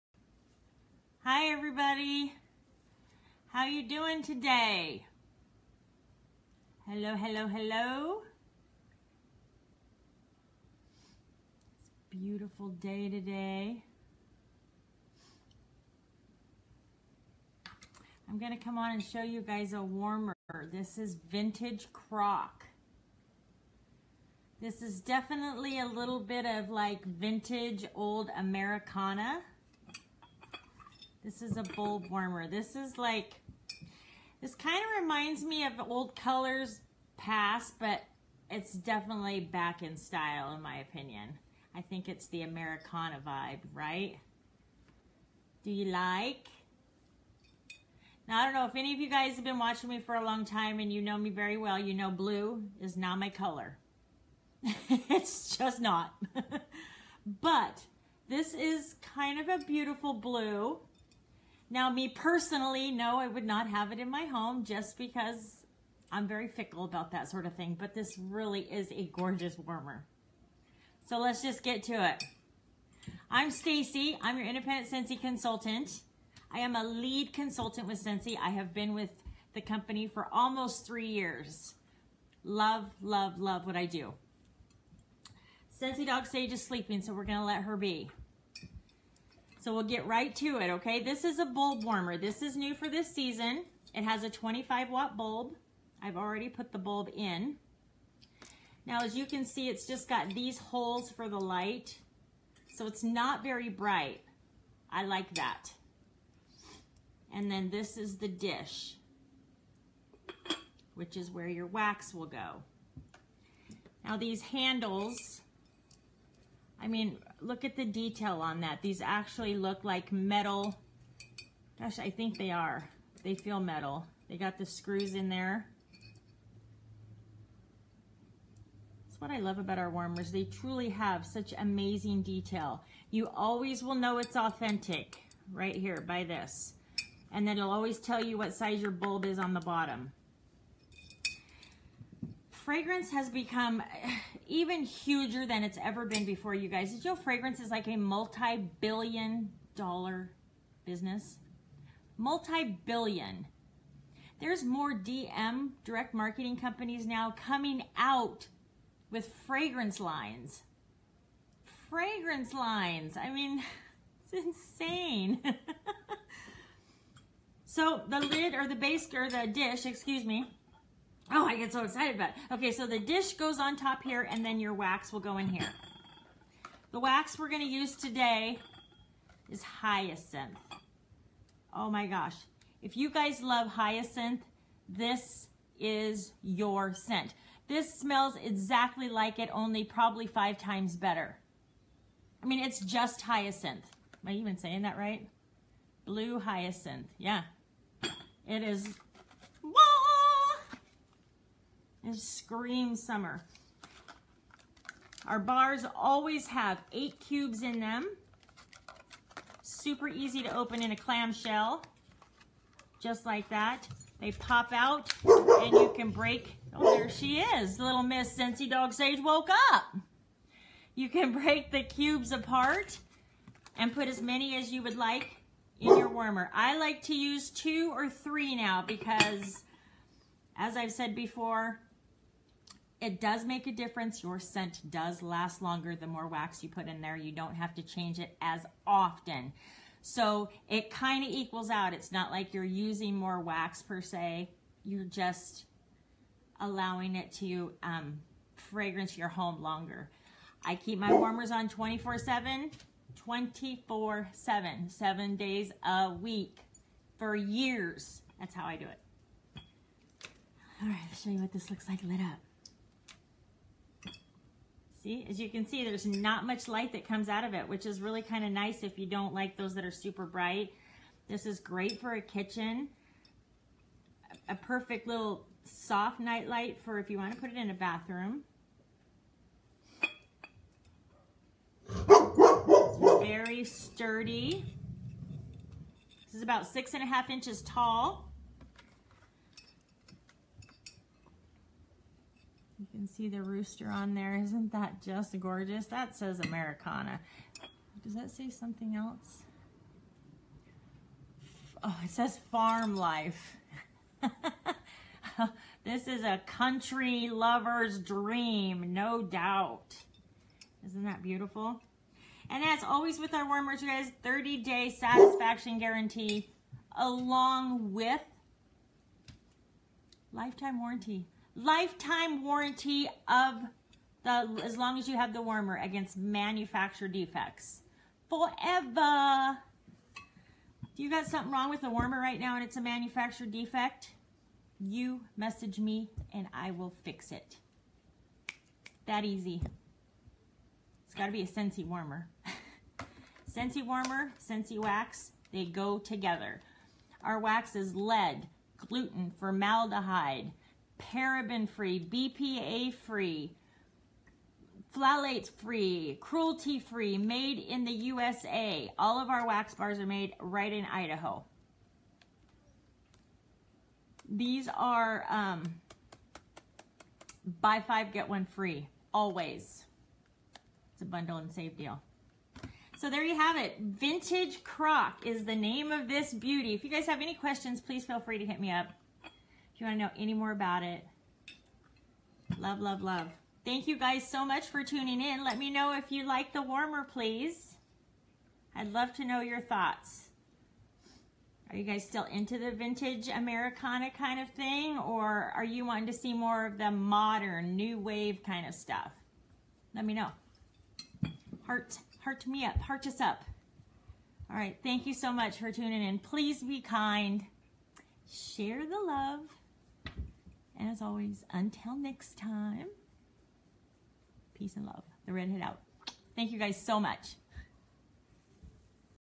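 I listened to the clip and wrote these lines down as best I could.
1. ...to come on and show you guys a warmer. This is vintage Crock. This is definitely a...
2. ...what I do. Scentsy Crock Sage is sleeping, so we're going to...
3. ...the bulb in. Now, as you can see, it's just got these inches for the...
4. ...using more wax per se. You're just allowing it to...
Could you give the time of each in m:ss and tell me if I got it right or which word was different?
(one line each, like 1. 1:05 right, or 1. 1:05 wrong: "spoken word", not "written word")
1. 0:18 right
2. 1:23 wrong: "Dog", not "Crock"
3. 1:36 wrong: "holes", not "inches"
4. 4:02 right.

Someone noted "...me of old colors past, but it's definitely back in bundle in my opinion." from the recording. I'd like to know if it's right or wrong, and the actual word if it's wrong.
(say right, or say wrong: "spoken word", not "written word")
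wrong: "style", not "bundle".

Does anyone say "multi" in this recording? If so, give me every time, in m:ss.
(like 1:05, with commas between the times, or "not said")
2:27, 2:32.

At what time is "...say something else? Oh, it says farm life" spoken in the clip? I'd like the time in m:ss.
4:58.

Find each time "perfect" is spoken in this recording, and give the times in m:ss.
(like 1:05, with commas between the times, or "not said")
4:34.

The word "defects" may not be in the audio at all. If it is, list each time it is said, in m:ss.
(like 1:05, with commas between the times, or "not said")
5:27, 5:33.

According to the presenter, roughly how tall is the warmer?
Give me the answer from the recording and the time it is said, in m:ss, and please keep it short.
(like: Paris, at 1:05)
6.5 inches, at 4:46.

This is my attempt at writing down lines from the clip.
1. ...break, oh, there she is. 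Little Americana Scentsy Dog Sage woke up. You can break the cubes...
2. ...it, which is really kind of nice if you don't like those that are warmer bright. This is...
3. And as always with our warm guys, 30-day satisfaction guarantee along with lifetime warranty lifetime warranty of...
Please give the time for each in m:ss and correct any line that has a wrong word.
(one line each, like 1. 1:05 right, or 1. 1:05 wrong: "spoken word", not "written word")
1. 3:36 wrong: "Miss", not "Americana"
2. 4:27 wrong: "super", not "warmer"
3. 5:12 right.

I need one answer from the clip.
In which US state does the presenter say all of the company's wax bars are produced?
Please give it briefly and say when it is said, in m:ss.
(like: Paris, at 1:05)
Idaho, at 6:00.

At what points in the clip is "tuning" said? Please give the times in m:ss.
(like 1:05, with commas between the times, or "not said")
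6:24, 6:45.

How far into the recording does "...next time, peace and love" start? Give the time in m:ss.
6:51.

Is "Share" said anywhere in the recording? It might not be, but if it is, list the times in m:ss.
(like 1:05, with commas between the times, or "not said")
6:48.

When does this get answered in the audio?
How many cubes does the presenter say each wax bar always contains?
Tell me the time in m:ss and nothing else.
3:26.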